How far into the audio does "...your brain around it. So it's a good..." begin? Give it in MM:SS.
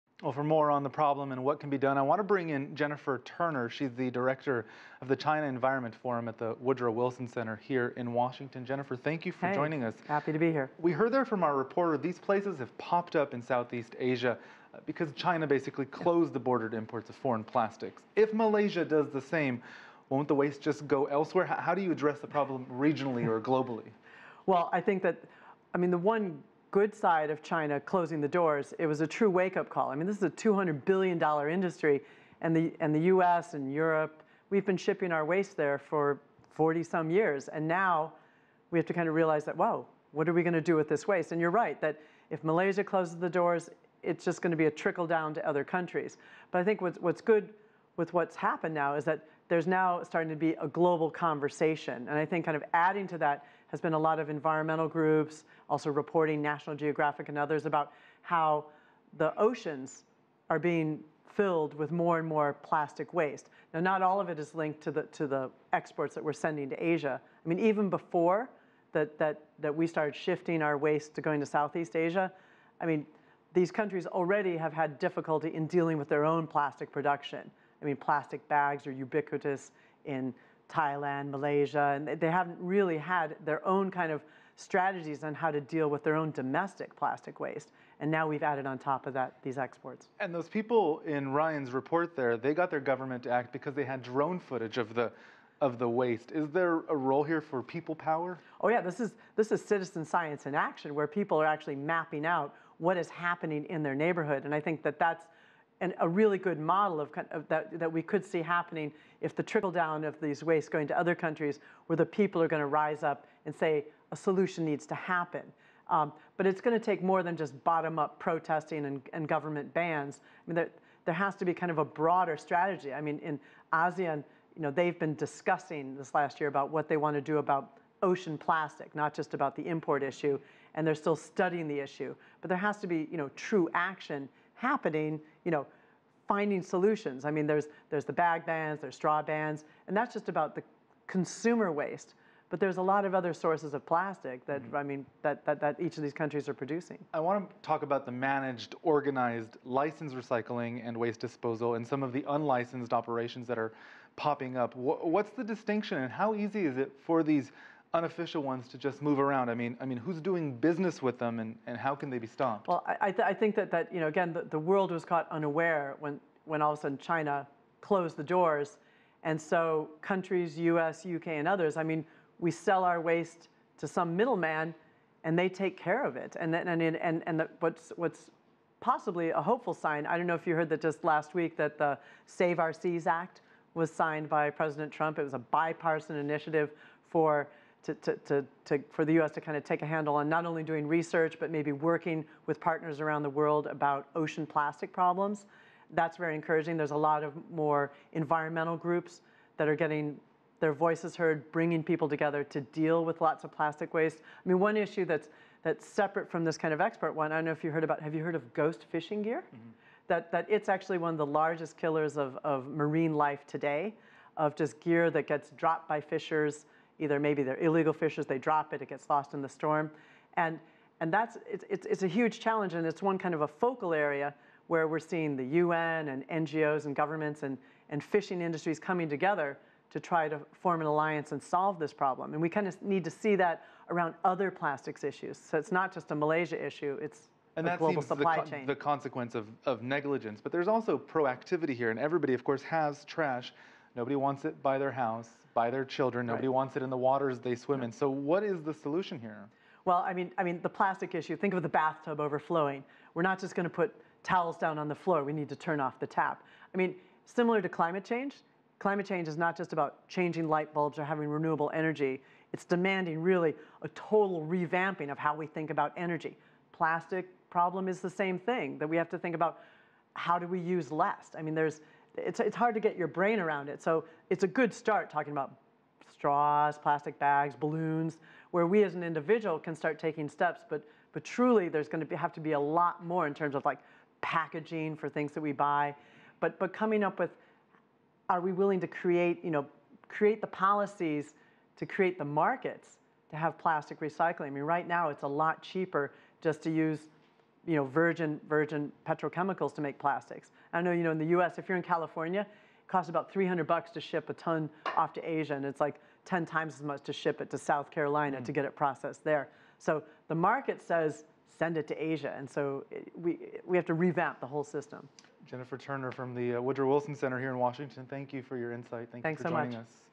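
04:32.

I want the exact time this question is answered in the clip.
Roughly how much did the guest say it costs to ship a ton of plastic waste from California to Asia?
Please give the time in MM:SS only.
05:03.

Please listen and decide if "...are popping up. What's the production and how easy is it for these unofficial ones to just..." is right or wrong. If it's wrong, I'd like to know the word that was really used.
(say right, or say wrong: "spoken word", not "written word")
wrong: "distinction", not "production".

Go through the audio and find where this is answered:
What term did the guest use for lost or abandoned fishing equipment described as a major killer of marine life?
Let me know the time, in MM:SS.
03:28.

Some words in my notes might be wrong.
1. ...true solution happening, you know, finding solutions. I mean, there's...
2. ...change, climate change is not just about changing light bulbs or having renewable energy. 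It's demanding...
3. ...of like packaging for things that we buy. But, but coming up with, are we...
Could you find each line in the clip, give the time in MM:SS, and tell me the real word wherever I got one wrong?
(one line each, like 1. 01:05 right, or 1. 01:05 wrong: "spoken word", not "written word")
1. 02:13 wrong: "action", not "solution"
2. 04:18 right
3. 04:43 right.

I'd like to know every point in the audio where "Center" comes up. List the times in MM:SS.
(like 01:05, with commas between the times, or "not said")
00:07, 05:17.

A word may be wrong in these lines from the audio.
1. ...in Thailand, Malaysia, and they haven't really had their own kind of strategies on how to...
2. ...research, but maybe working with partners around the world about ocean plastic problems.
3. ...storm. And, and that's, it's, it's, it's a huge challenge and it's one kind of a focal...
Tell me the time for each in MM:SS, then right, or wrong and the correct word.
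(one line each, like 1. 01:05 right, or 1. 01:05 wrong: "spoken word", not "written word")
1. 01:20 right
2. 03:10 right
3. 03:39 right.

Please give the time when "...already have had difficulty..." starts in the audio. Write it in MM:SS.
01:14.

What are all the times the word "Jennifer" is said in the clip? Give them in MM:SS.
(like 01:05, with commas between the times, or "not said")
00:02, 00:08, 05:15.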